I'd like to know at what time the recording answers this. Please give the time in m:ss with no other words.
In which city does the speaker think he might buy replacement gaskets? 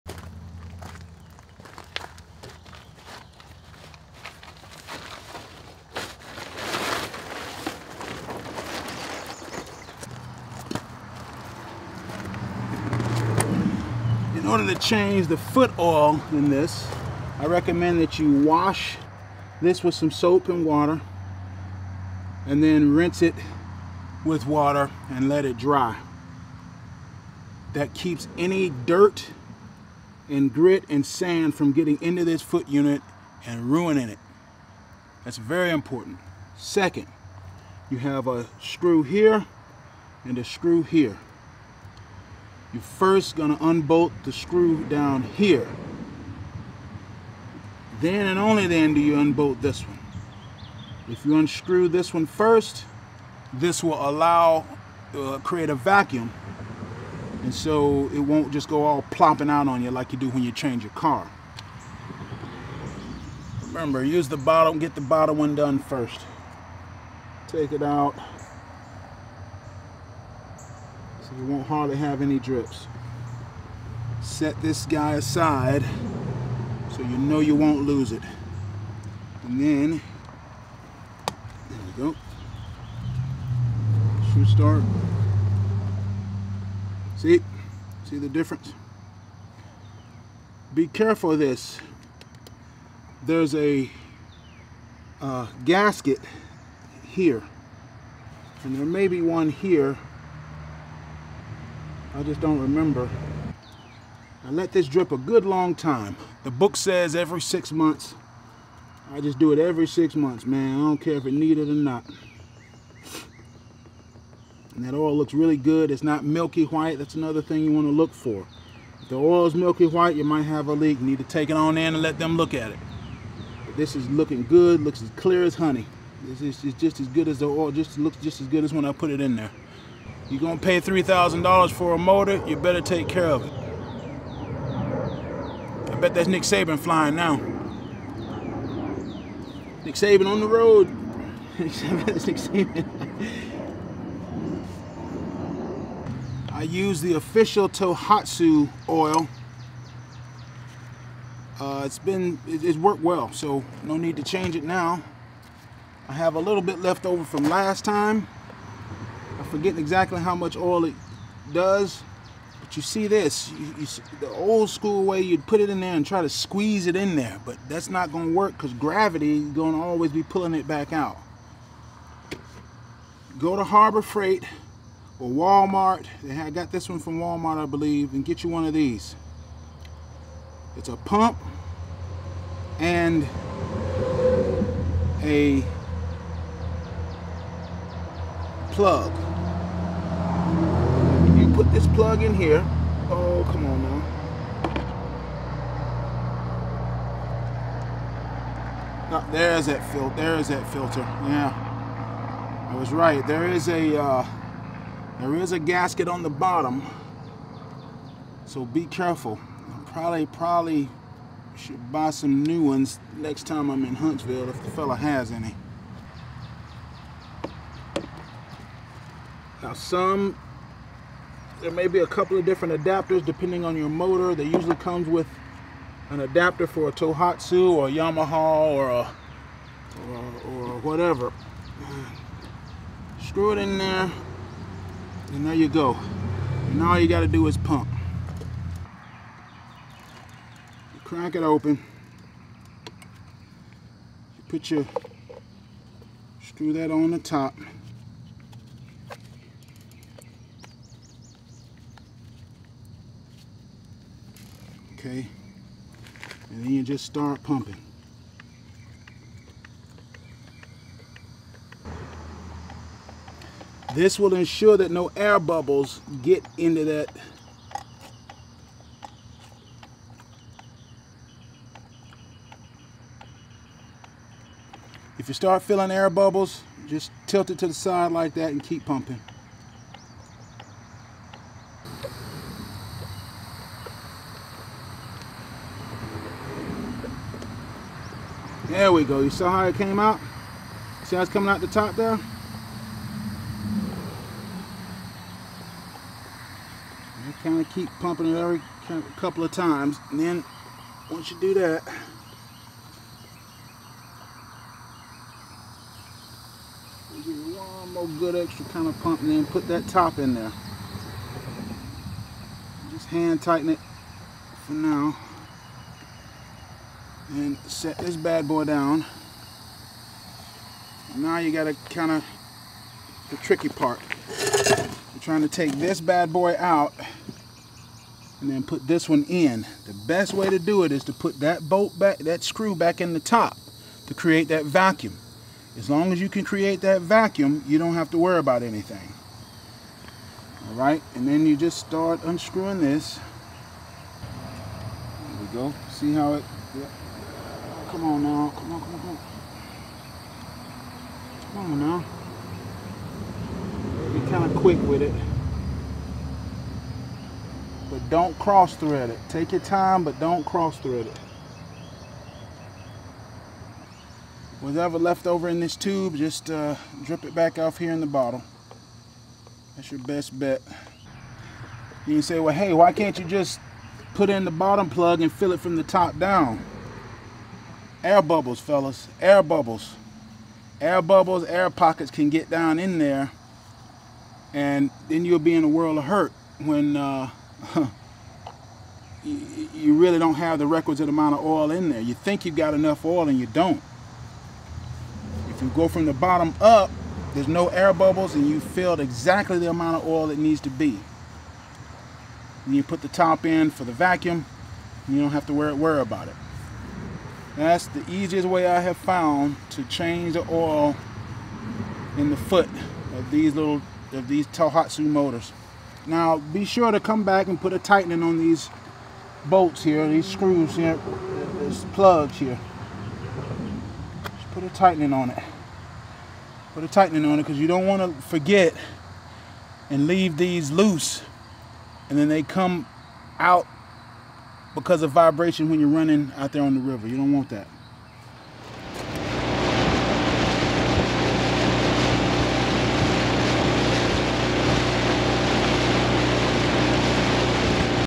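3:33.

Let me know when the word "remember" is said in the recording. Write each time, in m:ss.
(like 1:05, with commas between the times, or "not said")
1:03, 1:42.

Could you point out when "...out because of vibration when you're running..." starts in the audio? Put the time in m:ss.
7:13.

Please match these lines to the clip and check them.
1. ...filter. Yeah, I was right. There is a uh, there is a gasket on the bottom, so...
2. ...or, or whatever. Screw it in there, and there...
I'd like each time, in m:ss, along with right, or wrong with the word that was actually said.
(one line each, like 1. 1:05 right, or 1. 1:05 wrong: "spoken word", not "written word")
1. 3:20 right
2. 3:50 right.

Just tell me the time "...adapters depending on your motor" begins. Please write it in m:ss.
3:42.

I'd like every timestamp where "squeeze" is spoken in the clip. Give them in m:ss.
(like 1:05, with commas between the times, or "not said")
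2:46.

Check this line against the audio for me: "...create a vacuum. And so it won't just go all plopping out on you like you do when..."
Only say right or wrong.
right.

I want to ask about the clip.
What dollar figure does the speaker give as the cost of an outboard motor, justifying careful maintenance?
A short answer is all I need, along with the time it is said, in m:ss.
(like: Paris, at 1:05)
$3,000, at 2:10.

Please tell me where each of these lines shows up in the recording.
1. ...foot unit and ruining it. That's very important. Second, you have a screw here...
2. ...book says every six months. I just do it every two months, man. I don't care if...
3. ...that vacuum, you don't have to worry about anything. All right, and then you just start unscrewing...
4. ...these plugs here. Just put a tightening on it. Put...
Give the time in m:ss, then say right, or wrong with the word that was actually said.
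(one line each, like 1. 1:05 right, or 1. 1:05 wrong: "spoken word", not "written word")
1. 0:32 right
2. 1:46 wrong: "six", not "two"
3. 5:36 right
4. 7:01 right.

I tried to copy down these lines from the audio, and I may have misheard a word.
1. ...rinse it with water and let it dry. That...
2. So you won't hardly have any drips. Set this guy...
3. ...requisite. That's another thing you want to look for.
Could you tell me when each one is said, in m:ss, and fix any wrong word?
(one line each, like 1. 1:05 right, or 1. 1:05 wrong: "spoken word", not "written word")
1. 0:22 right
2. 1:11 right
3. 1:56 wrong: "white", not "requisite".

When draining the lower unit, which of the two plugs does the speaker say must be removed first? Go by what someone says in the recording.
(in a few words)
The bottom one.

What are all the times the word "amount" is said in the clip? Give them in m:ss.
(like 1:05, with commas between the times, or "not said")
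6:31, 6:39.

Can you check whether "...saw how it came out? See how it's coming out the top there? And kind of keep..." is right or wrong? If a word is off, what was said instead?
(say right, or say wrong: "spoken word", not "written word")
right.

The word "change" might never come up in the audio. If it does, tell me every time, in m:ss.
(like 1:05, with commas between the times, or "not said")
0:14, 1:00, 2:34, 6:49.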